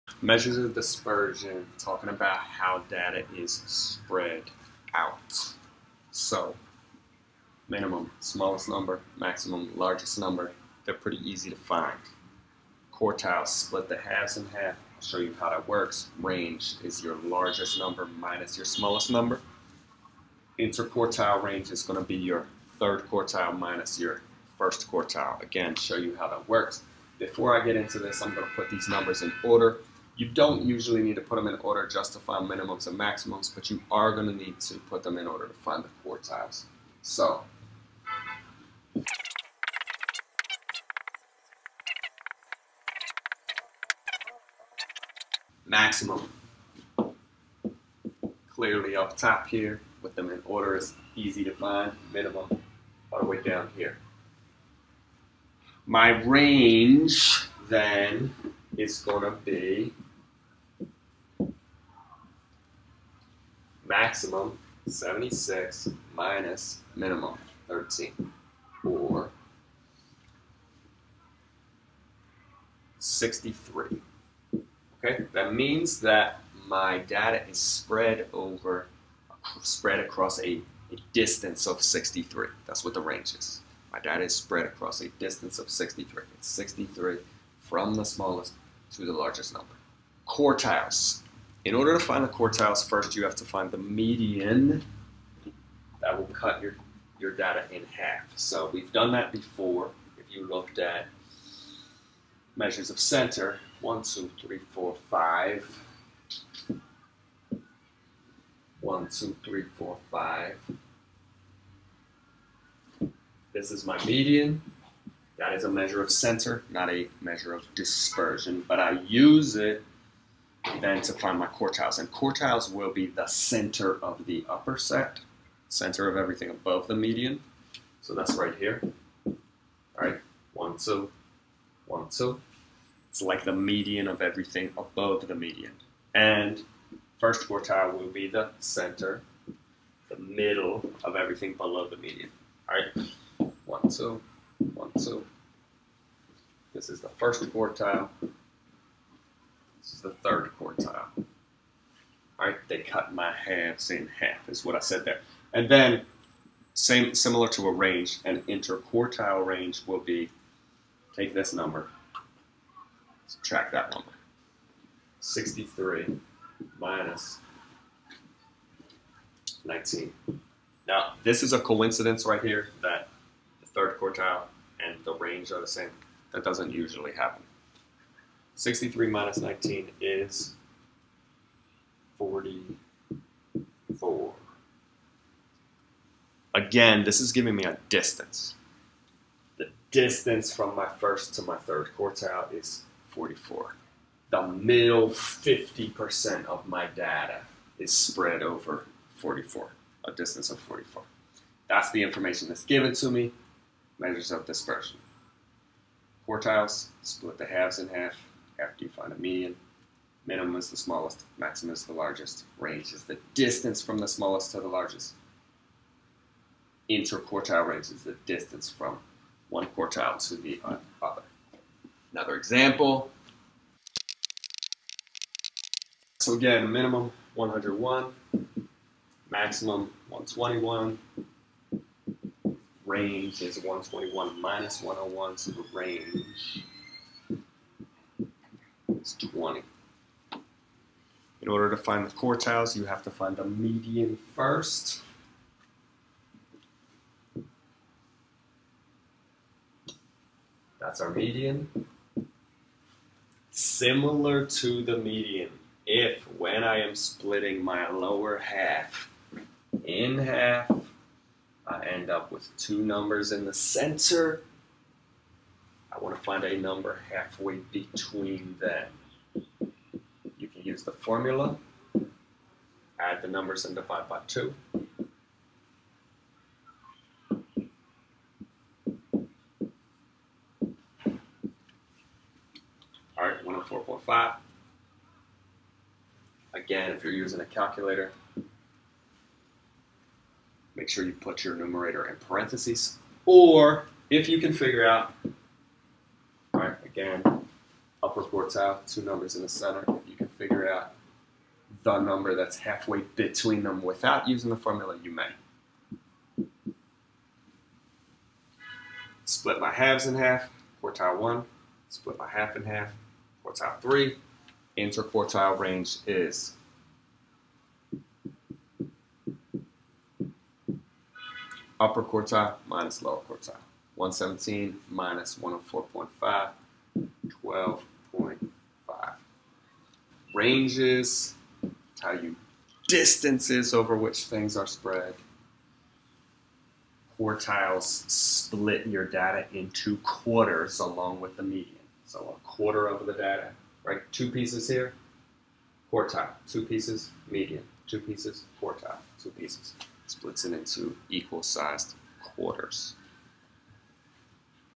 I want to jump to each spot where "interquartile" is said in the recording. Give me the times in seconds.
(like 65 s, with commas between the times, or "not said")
20 s, 158 s, 216 s, 314 s.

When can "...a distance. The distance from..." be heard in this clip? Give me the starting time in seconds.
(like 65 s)
187 s.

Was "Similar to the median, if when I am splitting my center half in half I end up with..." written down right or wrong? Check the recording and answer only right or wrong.
wrong.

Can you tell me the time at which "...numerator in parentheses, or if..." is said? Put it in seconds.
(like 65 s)
291 s.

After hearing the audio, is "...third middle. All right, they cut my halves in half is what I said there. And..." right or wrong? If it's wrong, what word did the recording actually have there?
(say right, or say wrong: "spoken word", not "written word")
wrong: "quartile", not "middle".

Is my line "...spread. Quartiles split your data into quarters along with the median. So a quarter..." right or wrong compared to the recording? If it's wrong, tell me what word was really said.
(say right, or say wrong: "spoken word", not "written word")
right.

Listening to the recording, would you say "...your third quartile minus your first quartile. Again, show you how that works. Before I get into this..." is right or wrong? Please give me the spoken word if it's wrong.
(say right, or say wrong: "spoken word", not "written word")
right.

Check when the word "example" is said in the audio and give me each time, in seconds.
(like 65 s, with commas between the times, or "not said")
222 s.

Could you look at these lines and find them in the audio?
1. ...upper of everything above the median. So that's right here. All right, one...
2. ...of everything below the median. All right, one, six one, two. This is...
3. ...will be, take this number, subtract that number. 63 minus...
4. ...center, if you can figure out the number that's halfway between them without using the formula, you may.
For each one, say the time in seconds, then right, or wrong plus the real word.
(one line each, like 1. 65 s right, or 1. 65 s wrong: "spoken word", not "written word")
1. 125 s wrong: "center", not "upper"
2. 141 s wrong: "two", not "six"
3. 159 s right
4. 299 s right.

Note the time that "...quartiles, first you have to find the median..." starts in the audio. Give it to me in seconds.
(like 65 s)
92 s.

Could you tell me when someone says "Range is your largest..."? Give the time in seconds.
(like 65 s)
16 s.